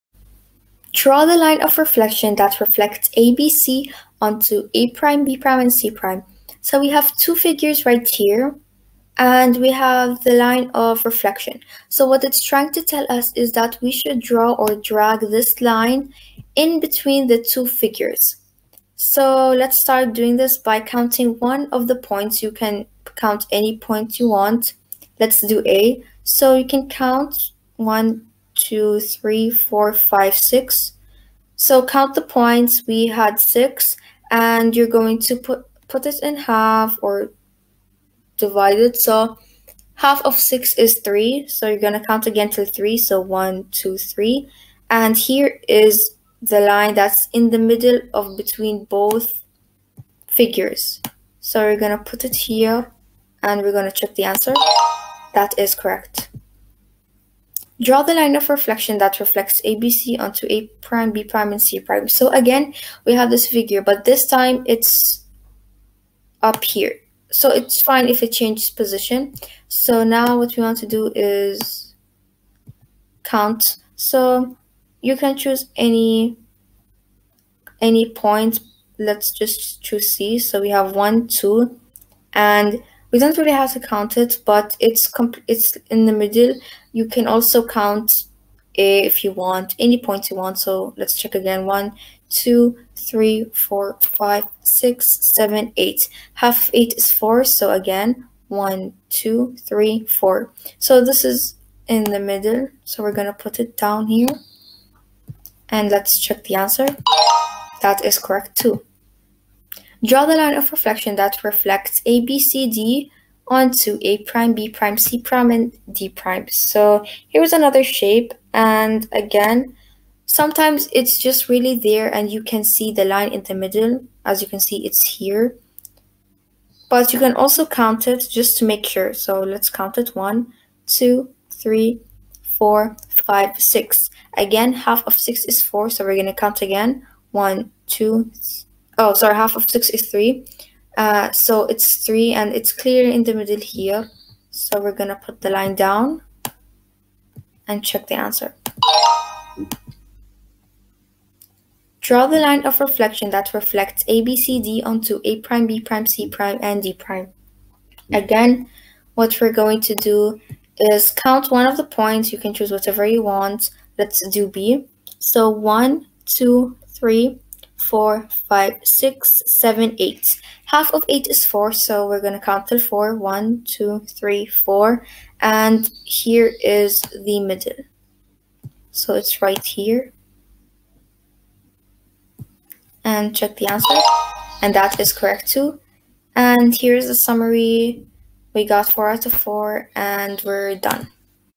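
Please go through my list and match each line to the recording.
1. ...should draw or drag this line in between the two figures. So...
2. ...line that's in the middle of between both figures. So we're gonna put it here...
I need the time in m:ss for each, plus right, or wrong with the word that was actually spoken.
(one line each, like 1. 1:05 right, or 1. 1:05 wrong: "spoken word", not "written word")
1. 0:13 right
2. 0:46 right.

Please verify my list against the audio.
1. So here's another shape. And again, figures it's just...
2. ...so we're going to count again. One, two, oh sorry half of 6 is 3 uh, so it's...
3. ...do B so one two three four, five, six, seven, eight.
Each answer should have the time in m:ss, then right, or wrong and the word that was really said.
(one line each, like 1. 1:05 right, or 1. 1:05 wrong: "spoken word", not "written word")
1. 1:56 wrong: "sometimes", not "figures"
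2. 2:15 right
3. 2:44 right.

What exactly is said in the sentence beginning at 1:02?
So again, we have this figure, but this time it's up here.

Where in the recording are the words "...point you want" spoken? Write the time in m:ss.
0:23.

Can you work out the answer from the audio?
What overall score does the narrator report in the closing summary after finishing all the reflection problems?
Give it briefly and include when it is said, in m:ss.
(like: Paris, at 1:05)
4 out of 4, at 3:08.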